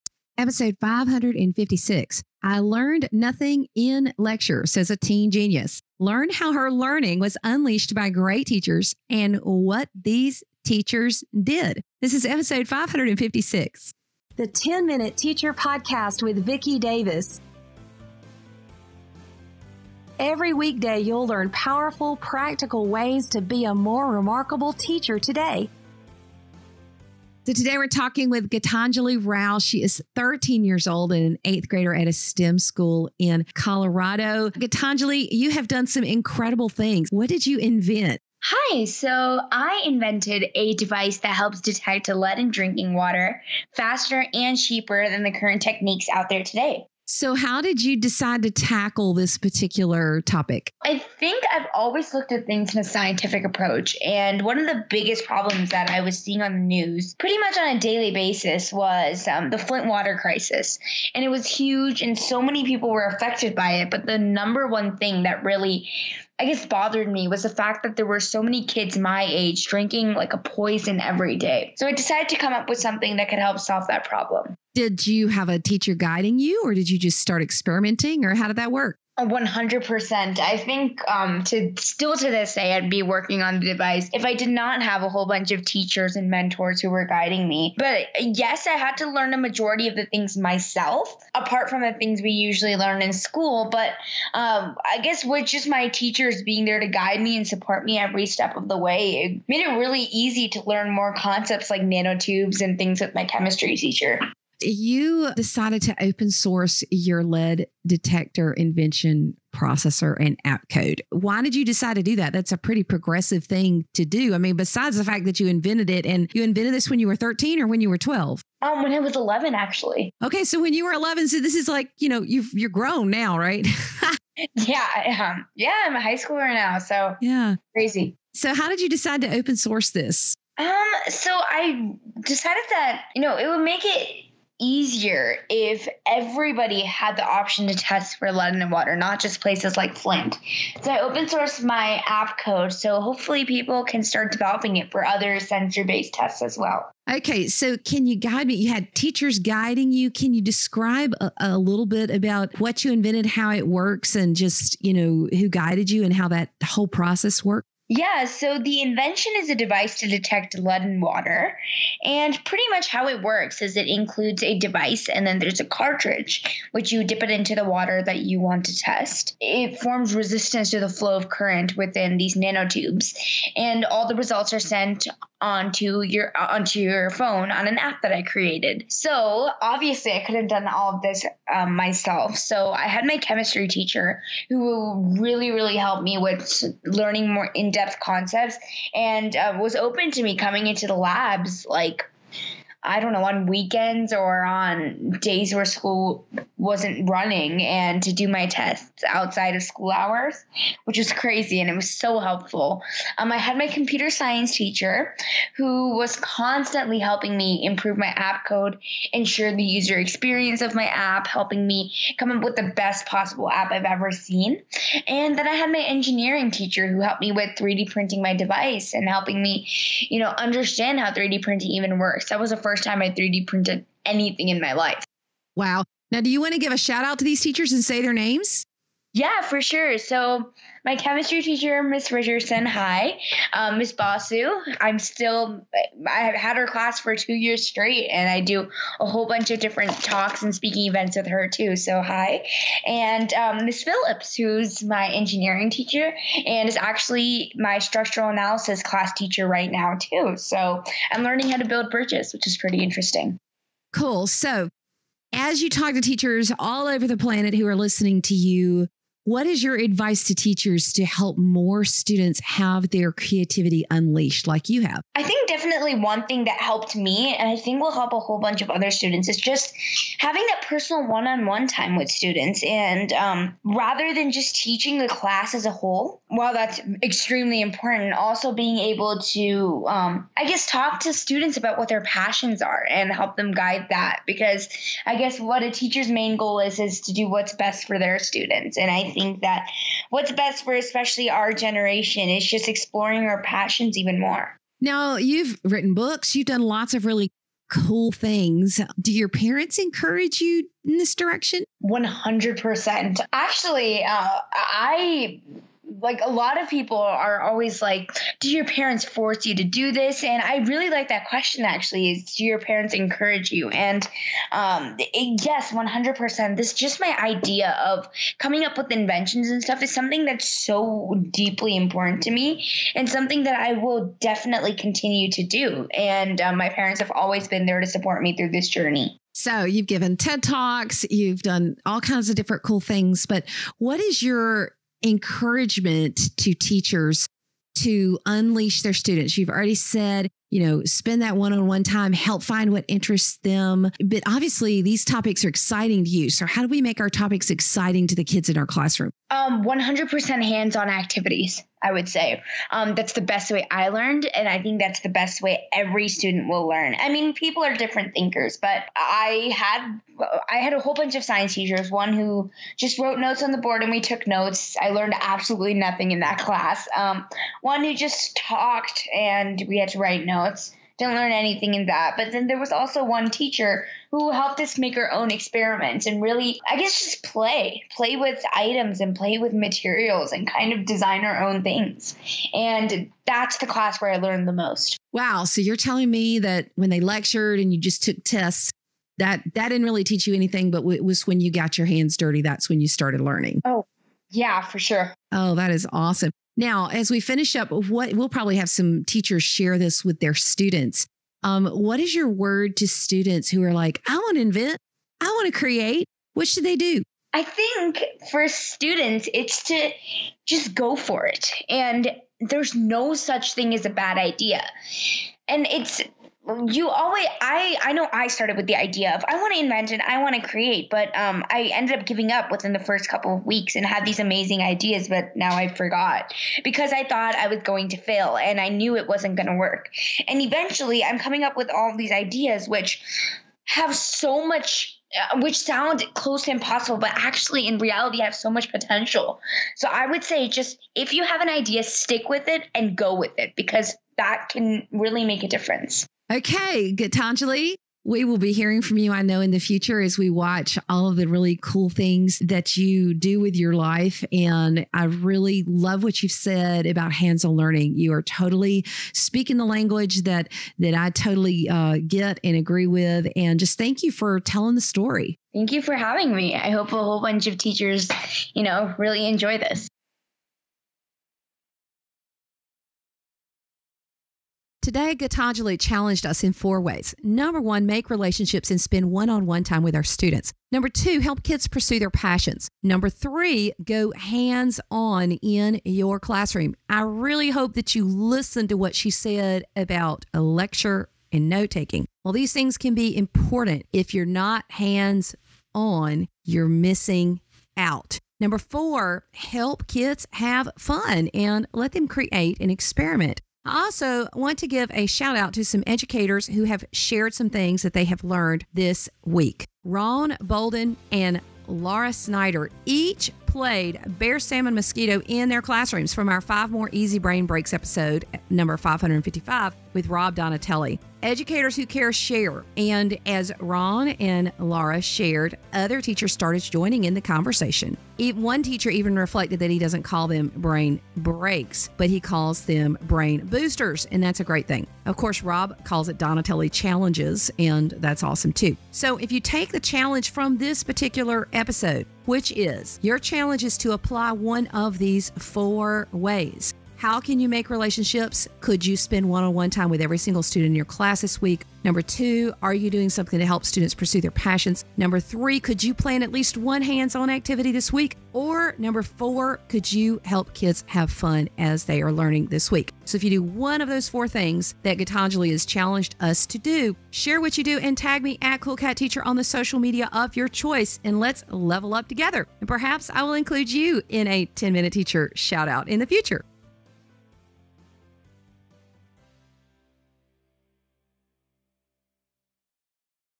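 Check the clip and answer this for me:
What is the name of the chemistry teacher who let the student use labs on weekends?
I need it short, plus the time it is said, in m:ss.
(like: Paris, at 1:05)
Miss Richardson, at 3:51.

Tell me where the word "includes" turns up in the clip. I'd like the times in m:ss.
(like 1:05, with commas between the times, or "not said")
2:43, 9:33.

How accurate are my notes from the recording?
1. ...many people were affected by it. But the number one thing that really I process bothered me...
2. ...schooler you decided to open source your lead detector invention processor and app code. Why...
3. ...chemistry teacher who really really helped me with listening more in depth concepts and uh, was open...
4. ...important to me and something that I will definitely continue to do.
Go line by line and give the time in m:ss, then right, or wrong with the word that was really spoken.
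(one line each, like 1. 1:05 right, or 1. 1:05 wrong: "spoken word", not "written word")
1. 1:02 wrong: "guess", not "process"
2. 1:43 wrong: "teacher", not "schooler"
3. 3:03 wrong: "learning", not "listening"
4. 5:21 right.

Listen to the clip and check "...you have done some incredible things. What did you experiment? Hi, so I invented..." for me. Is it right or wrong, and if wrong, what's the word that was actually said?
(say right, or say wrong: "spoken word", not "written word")
wrong: "invent", not "experiment".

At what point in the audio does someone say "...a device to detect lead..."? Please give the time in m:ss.
2:39.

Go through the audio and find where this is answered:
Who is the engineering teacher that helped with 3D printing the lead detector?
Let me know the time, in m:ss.
4:03.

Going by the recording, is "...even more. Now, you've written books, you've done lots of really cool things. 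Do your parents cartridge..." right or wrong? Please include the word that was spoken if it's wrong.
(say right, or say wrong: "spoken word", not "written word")
wrong: "encourage", not "cartridge".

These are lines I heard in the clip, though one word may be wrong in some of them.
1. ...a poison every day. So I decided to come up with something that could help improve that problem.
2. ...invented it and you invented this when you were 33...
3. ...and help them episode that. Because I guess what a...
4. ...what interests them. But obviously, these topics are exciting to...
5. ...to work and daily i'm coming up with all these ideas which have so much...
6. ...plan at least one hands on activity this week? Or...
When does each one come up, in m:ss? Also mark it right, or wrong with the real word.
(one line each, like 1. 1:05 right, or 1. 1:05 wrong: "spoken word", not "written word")
1. 1:10 wrong: "solve", not "improve"
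2. 1:55 wrong: "13", not "33"
3. 4:42 wrong: "guide", not "episode"
4. 5:42 right
5. 7:09 wrong: "eventually", not "daily"
6. 9:15 right.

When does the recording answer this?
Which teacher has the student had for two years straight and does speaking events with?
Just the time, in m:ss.
3:53.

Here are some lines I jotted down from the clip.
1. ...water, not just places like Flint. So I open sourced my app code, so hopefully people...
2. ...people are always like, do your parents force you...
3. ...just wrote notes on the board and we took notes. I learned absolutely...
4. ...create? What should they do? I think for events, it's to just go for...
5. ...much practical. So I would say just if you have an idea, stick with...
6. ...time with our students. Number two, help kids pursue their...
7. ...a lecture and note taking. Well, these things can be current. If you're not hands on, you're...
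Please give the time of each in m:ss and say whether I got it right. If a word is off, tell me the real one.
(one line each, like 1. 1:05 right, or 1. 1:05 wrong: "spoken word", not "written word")
1. 2:18 right
2. 5:06 right
3. 6:02 right
4. 6:45 wrong: "students", not "events"
5. 7:18 wrong: "potential", not "practical"
6. 7:59 right
7. 8:10 wrong: "important", not "current".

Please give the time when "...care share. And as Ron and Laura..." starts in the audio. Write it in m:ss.
8:41.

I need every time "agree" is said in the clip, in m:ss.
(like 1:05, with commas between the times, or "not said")
7:42.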